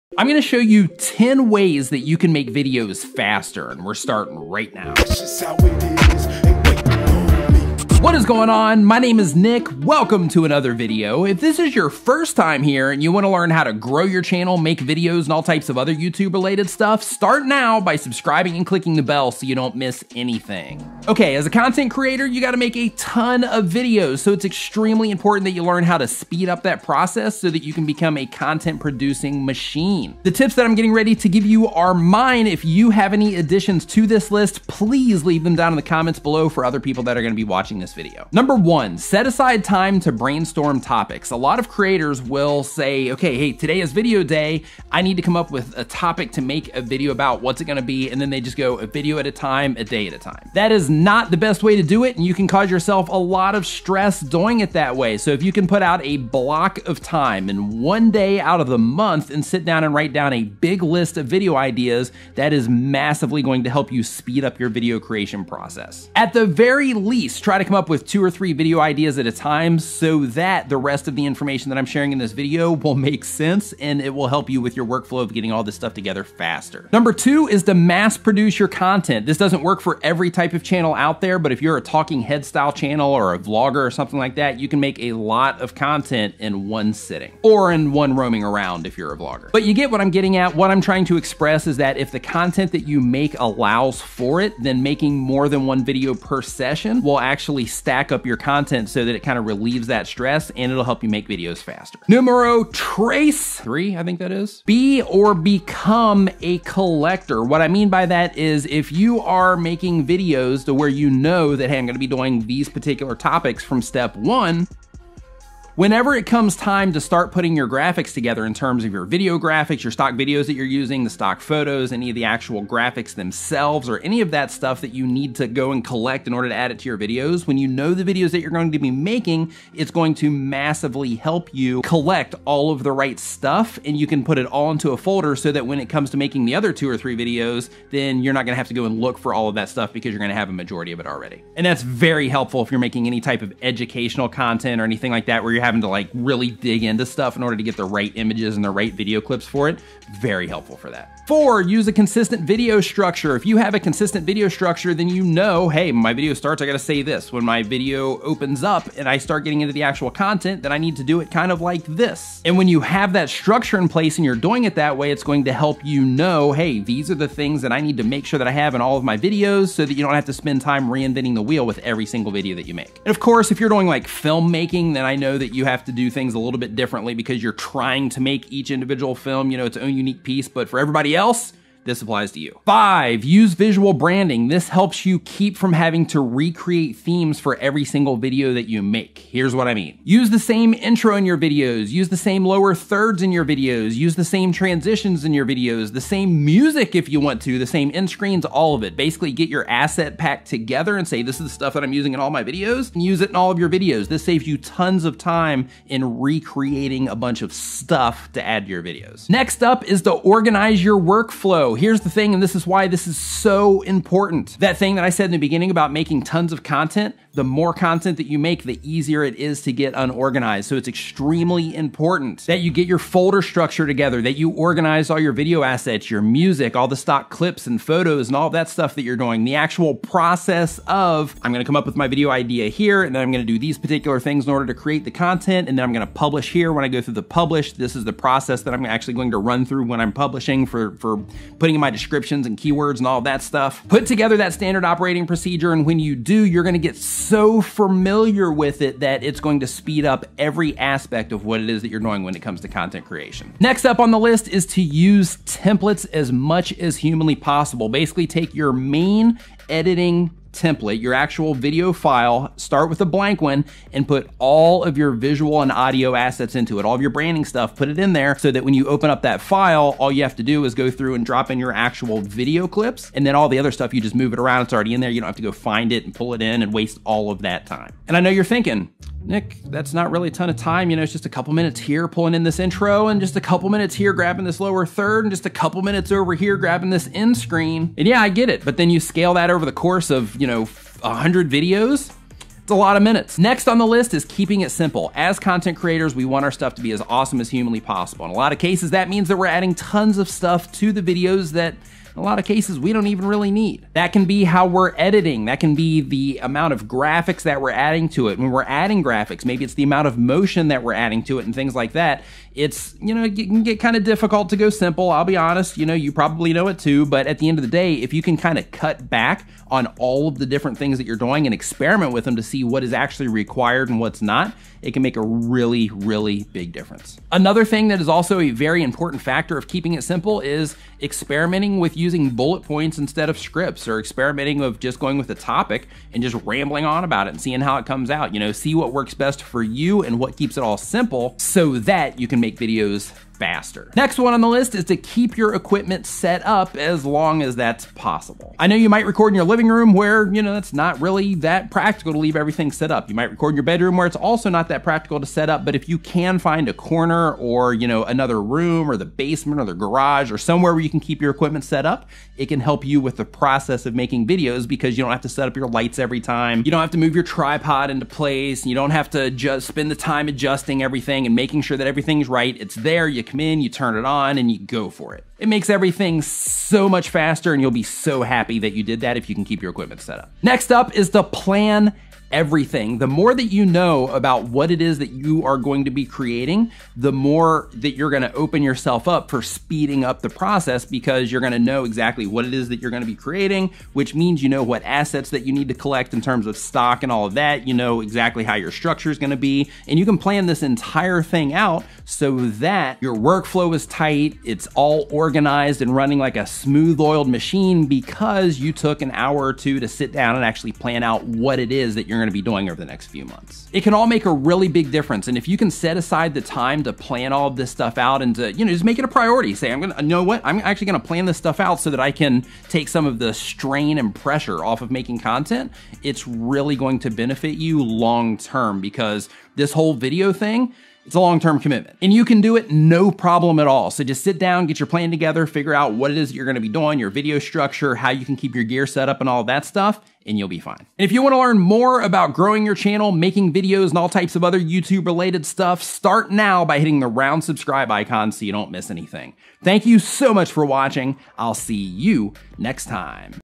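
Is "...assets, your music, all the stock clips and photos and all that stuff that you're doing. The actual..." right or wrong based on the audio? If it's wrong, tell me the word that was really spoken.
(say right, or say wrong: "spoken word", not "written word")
right.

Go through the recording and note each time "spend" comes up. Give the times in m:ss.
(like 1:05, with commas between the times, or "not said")
2:50, 6:09.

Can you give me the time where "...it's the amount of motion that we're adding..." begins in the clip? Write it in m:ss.
5:09.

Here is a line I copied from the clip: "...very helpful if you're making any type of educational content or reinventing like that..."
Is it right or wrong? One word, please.
wrong.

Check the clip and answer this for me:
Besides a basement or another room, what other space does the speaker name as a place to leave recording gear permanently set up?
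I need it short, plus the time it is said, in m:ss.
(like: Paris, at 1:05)
the garage, at 5:59.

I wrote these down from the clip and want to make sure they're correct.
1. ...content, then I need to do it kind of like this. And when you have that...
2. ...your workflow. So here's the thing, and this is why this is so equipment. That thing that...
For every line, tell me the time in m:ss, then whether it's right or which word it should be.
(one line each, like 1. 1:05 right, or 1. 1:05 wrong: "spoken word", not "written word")
1. 2:40 right
2. 3:30 wrong: "important", not "equipment".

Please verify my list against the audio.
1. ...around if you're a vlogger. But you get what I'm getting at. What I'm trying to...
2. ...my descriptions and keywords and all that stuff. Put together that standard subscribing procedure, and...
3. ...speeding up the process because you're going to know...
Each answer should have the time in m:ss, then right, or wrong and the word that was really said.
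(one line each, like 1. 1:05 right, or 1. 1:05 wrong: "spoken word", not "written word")
1. 1:28 right
2. 4:01 wrong: "operating", not "subscribing"
3. 6:29 right.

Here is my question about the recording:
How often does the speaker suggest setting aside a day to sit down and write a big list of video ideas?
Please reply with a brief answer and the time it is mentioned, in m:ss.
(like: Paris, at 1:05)
one day out of the month, at 0:57.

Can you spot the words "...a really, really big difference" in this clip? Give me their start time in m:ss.
5:25.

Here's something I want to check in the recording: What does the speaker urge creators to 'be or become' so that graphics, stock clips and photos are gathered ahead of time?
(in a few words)
a collector.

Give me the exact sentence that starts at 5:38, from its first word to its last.
You know, see what works best for you and what keeps it all simple so that you can make videos faster.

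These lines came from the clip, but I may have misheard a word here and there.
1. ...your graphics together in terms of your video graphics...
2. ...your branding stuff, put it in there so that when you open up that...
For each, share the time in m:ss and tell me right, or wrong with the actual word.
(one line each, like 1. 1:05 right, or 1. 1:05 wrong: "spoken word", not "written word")
1. 1:57 right
2. 4:27 right.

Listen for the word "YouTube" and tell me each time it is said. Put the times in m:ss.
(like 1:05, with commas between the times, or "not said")
0:15, 7:24.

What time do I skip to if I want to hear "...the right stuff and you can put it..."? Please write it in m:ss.
2:12.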